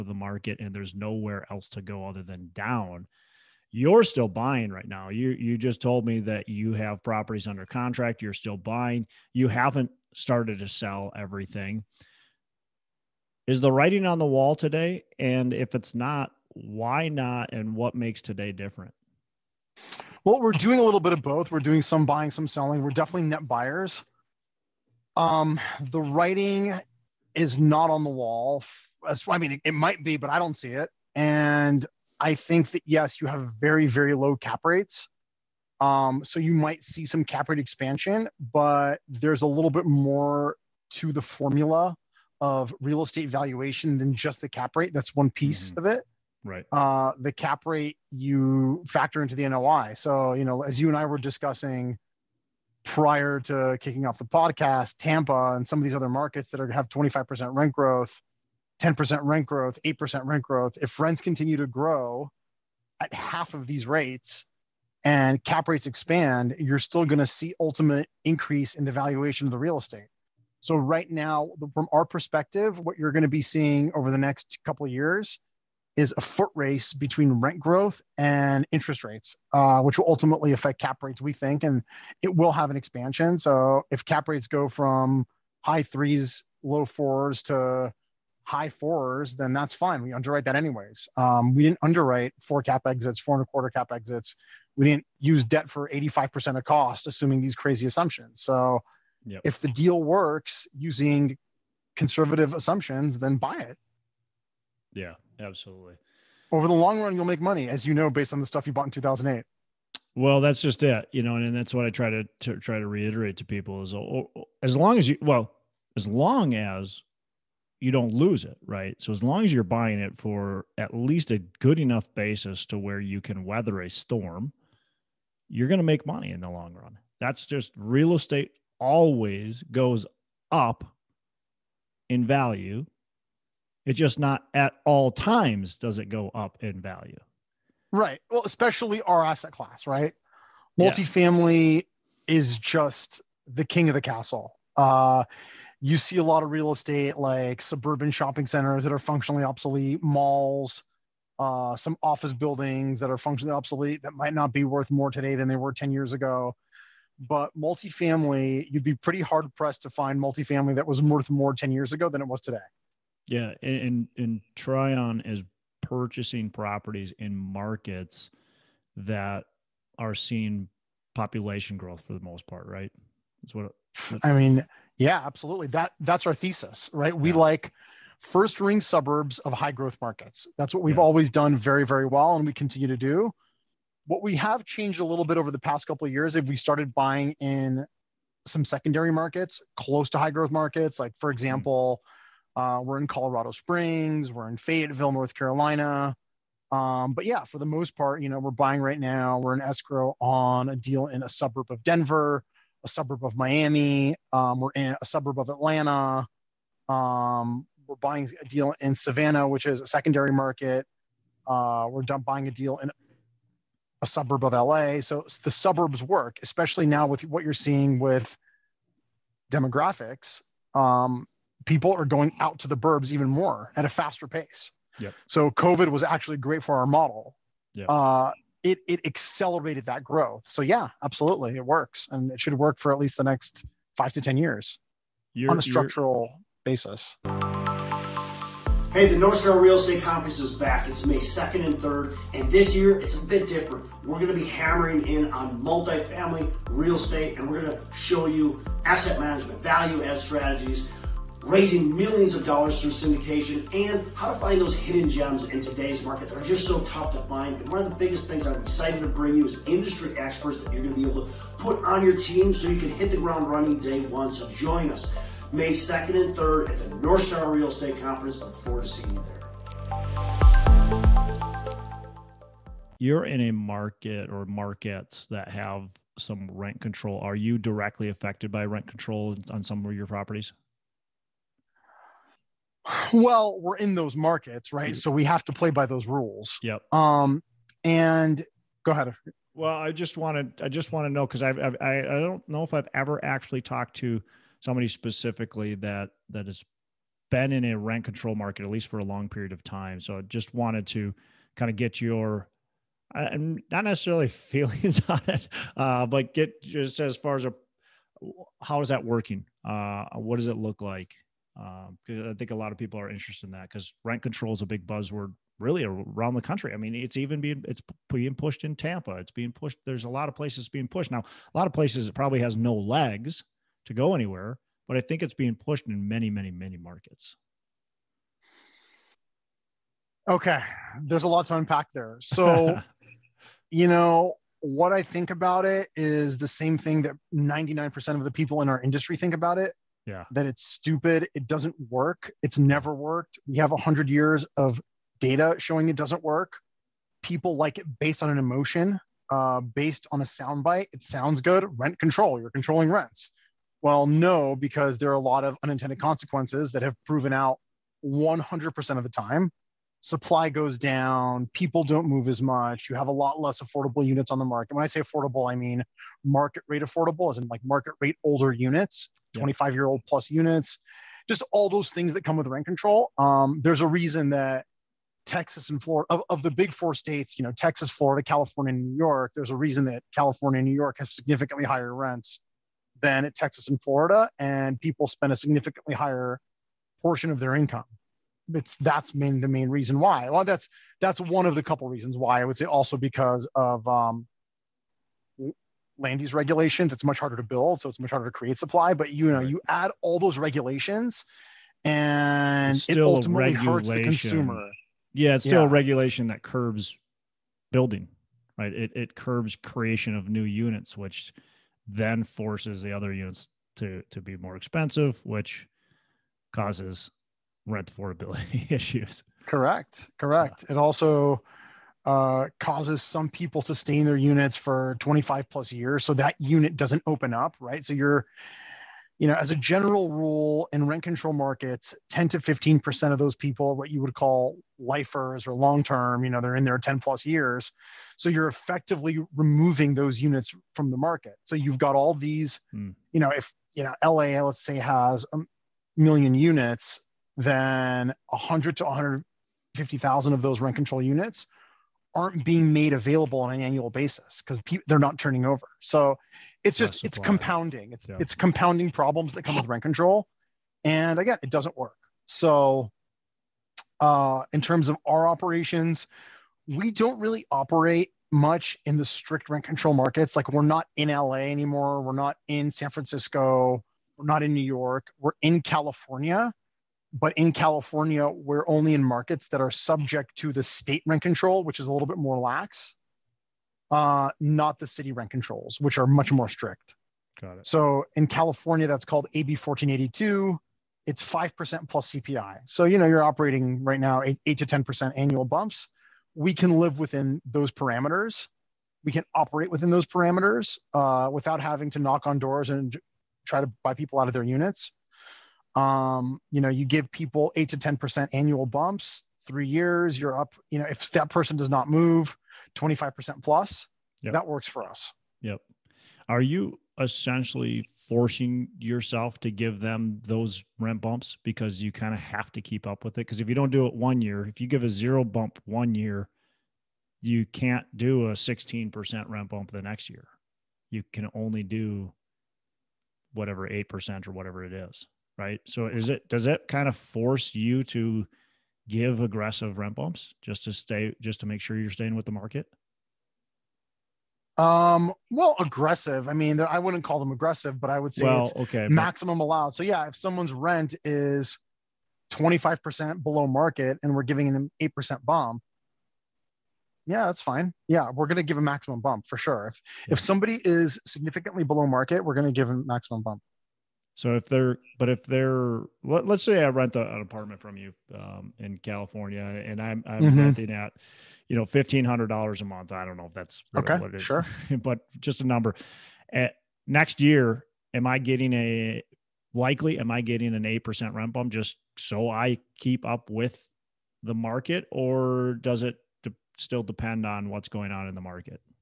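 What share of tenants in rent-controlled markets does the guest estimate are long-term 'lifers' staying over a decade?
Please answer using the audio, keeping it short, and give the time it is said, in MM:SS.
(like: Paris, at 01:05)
10 to 15%, at 07:12.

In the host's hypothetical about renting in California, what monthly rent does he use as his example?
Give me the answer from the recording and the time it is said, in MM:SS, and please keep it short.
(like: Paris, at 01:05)
$1,500, at 09:31.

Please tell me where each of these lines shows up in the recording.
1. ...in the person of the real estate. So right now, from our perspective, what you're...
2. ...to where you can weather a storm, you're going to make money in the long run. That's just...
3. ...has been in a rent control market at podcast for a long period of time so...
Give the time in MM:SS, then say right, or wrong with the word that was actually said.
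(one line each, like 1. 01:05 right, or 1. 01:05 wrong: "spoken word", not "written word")
1. 01:08 wrong: "valuation", not "person"
2. 02:02 right
3. 04:56 wrong: "least", not "podcast".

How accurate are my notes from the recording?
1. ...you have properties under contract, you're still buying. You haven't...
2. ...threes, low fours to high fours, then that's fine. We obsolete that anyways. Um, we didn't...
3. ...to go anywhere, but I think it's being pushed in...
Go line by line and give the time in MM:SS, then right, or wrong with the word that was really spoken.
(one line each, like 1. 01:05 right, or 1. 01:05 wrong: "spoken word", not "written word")
1. 00:06 right
2. 01:25 wrong: "underwrite", not "obsolete"
3. 05:23 right.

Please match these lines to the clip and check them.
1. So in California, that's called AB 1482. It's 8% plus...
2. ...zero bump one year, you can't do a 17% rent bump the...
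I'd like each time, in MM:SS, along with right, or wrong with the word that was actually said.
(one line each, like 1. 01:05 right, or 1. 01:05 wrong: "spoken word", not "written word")
1. 08:07 wrong: "5", not "8"
2. 08:44 wrong: "16", not "17".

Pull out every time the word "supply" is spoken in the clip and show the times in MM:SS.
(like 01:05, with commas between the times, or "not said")
06:00, 06:38.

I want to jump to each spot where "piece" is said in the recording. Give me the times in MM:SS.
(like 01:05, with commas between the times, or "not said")
00:45.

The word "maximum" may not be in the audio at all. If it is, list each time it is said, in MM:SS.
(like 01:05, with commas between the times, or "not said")
09:08, 09:18, 09:22.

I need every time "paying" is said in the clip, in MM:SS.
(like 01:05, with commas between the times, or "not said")
not said.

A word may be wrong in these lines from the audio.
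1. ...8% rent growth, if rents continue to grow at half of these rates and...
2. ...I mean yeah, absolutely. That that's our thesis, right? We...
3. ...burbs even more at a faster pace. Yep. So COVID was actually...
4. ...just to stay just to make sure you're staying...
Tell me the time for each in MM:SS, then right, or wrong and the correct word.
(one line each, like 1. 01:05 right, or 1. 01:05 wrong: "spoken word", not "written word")
1. 00:59 right
2. 02:54 right
3. 03:42 right
4. 09:00 right.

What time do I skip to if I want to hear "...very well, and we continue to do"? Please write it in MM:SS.
03:01.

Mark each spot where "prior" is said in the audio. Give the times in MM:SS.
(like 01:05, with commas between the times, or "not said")
00:52.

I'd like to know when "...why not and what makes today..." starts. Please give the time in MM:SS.
00:16.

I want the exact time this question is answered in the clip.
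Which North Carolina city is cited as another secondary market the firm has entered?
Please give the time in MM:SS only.
03:14.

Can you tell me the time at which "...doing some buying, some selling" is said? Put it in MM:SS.
00:21.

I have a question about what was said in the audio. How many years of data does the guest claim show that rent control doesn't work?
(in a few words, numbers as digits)
100 years.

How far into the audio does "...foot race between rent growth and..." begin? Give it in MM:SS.
01:16.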